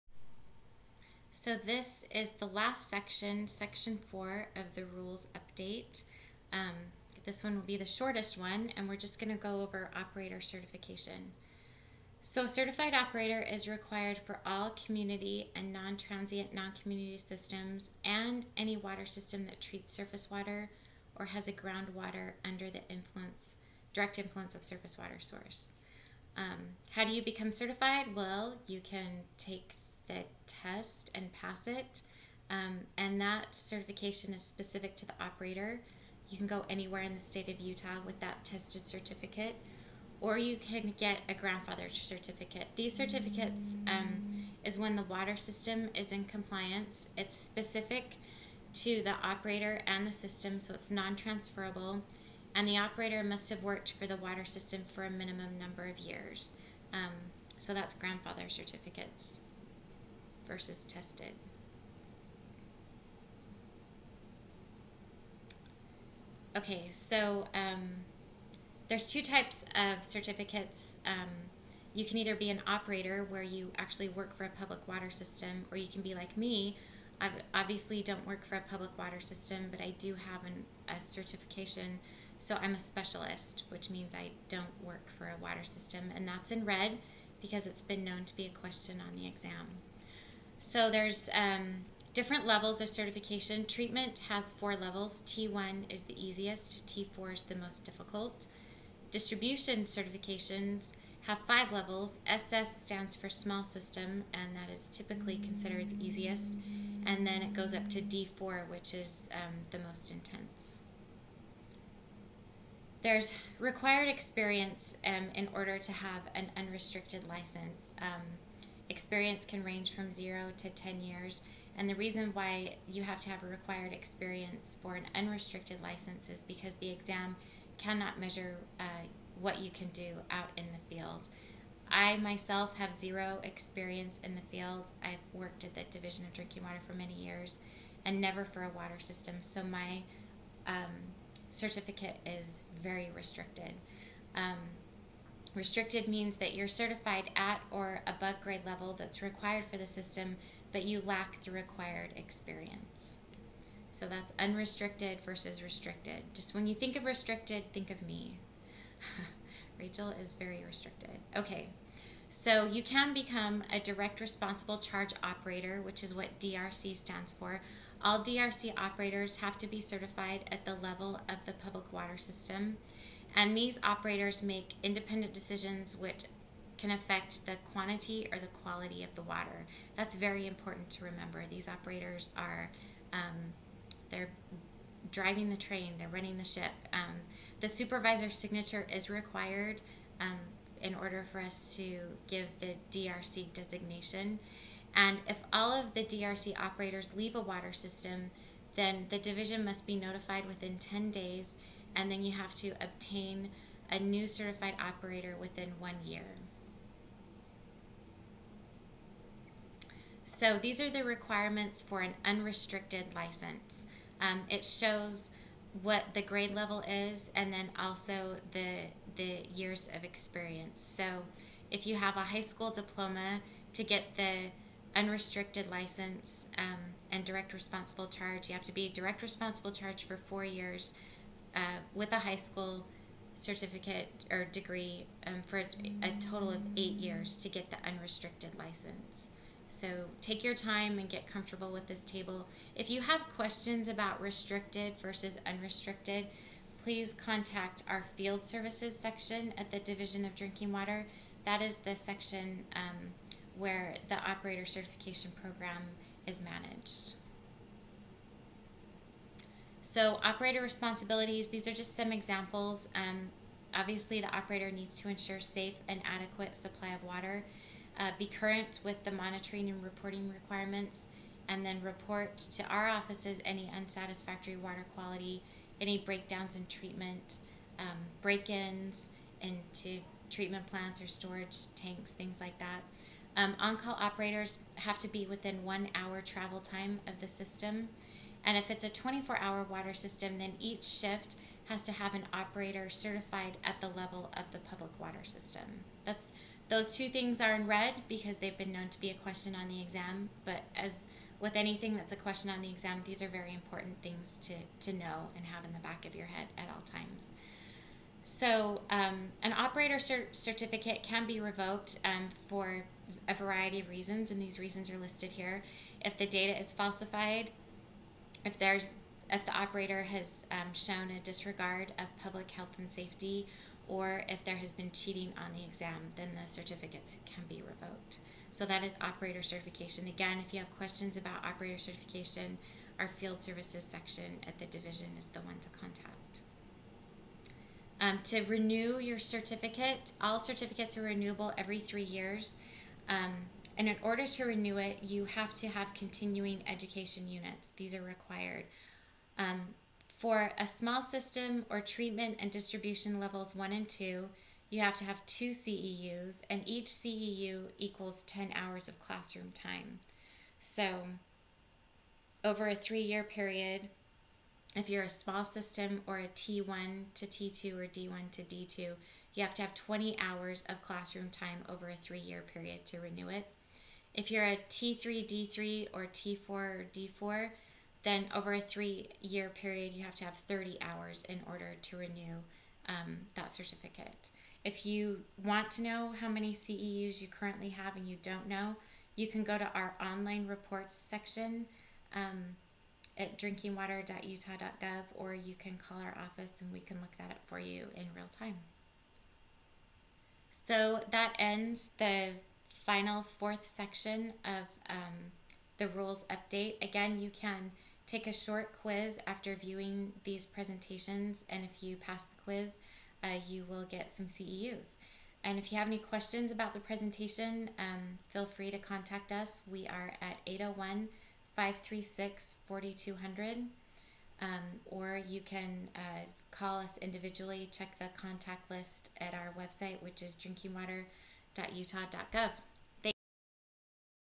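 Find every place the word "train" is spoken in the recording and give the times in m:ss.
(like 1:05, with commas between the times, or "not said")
3:05.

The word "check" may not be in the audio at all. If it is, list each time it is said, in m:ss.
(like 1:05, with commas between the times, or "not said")
7:07.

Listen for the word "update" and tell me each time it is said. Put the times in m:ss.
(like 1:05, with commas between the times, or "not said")
0:05, 6:46.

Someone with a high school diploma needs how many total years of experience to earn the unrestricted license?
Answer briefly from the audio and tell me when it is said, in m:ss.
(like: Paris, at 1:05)
8 years, at 3:56.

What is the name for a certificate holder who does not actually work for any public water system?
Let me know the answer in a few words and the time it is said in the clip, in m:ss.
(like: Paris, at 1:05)
Specialist, at 1:22.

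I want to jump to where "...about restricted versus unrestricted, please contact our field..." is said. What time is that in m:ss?
4:03.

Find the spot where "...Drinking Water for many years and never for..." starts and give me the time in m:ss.
2:16.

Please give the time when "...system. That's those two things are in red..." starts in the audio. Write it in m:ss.
4:55.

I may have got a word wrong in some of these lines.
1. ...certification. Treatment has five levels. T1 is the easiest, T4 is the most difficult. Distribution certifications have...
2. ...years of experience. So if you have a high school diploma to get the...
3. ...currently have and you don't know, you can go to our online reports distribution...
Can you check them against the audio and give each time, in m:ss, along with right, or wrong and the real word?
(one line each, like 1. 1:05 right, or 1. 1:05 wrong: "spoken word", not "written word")
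1. 1:32 wrong: "four", not "five"
2. 3:39 right
3. 6:27 wrong: "section", not "distribution".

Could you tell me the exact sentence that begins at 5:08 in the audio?
So um, an operator cert certificate can be revoked um, for a variety of reasons, and these reasons are listed here.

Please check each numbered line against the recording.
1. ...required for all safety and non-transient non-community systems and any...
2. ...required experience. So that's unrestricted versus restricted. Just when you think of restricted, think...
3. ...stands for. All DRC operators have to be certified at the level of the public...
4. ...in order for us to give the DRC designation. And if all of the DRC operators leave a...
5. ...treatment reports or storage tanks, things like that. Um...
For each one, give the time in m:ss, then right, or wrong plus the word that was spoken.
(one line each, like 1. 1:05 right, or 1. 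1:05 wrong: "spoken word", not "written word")
1. 0:13 wrong: "community", not "safety"
2. 2:31 right
3. 2:46 right
4. 3:10 right
5. 4:40 wrong: "plants", not "reports".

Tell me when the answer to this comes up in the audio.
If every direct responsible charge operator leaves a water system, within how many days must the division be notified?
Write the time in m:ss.
3:20.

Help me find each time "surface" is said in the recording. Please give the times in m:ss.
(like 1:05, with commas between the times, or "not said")
0:19, 0:24.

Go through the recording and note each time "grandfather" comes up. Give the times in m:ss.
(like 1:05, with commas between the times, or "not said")
0:41, 0:57.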